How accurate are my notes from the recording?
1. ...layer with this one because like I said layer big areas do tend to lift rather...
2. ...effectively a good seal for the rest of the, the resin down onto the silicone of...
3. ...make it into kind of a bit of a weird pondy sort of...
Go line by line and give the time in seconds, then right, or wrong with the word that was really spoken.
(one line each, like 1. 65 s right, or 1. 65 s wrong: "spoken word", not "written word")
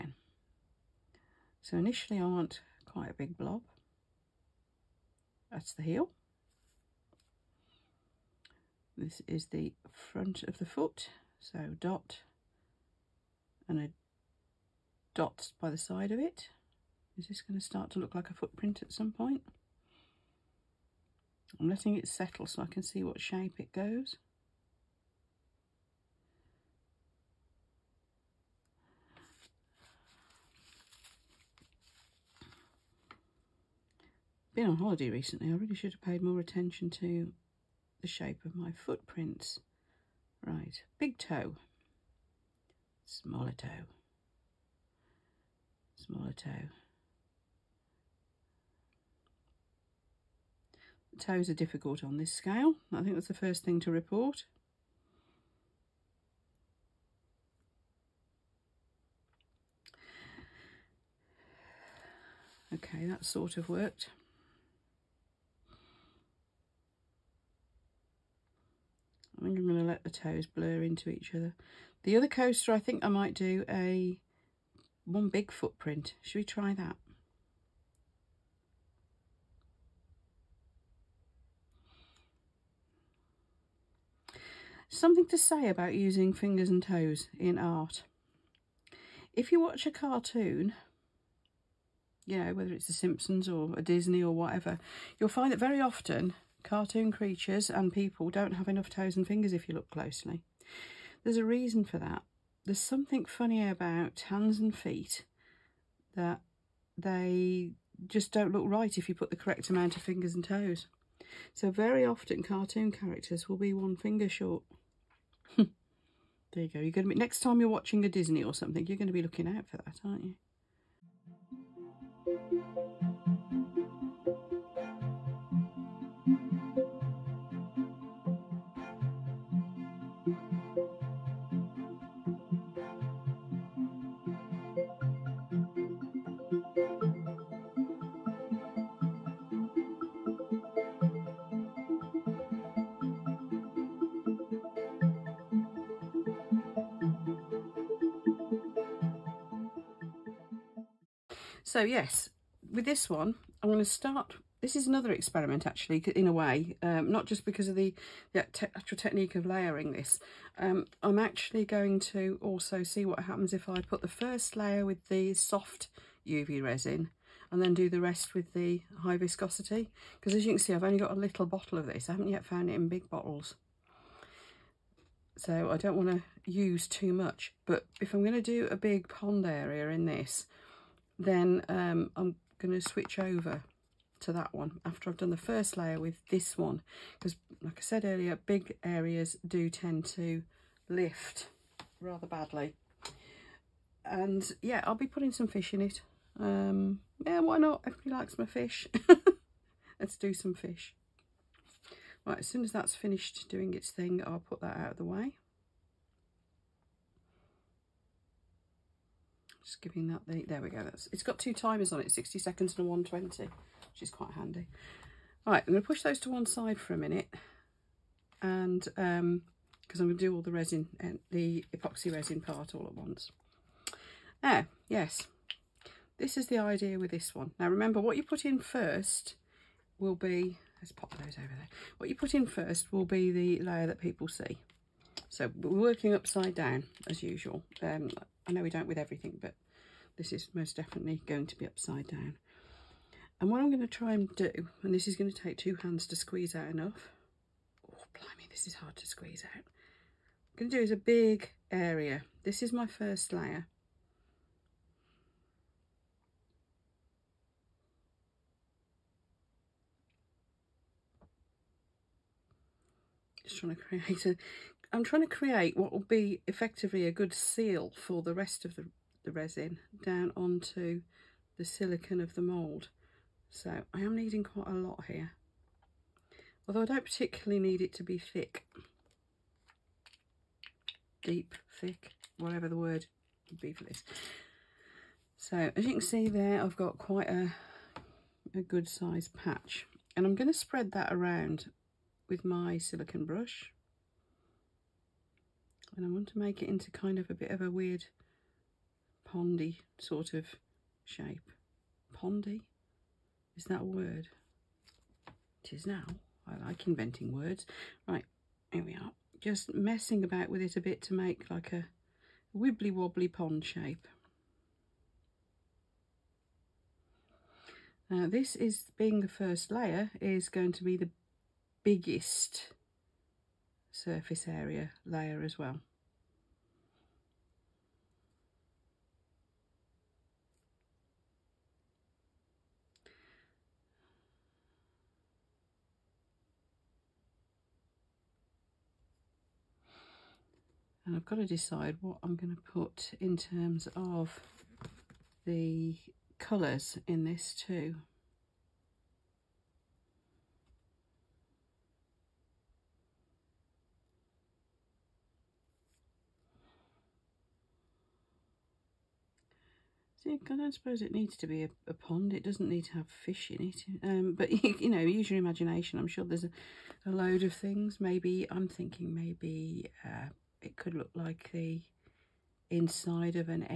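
1. 185 s wrong: "earlier", not "layer"
2. 266 s right
3. 296 s right.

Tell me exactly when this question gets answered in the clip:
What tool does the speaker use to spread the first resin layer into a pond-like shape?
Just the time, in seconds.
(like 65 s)
292 s.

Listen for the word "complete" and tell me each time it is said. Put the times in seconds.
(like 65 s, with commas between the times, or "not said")
not said.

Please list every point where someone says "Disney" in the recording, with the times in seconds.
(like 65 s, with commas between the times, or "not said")
93 s, 118 s.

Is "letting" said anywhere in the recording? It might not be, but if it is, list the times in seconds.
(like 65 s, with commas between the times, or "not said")
21 s.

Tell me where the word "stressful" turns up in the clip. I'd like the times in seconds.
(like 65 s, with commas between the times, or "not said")
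not said.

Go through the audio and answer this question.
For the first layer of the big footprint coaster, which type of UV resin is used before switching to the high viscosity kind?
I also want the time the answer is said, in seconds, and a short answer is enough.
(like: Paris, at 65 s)
Soft UV resin, at 165 s.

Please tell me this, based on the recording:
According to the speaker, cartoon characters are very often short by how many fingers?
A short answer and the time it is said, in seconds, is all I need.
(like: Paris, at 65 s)
1, at 113 s.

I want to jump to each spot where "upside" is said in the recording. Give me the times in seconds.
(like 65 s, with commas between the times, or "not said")
236 s, 241 s.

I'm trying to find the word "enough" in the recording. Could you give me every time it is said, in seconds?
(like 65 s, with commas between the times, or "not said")
98 s, 246 s.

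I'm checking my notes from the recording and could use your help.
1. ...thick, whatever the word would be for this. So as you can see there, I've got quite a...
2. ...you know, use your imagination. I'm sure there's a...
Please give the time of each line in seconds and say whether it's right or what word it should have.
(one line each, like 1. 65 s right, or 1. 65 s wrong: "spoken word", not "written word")
1. 281 s right
2. 364 s right.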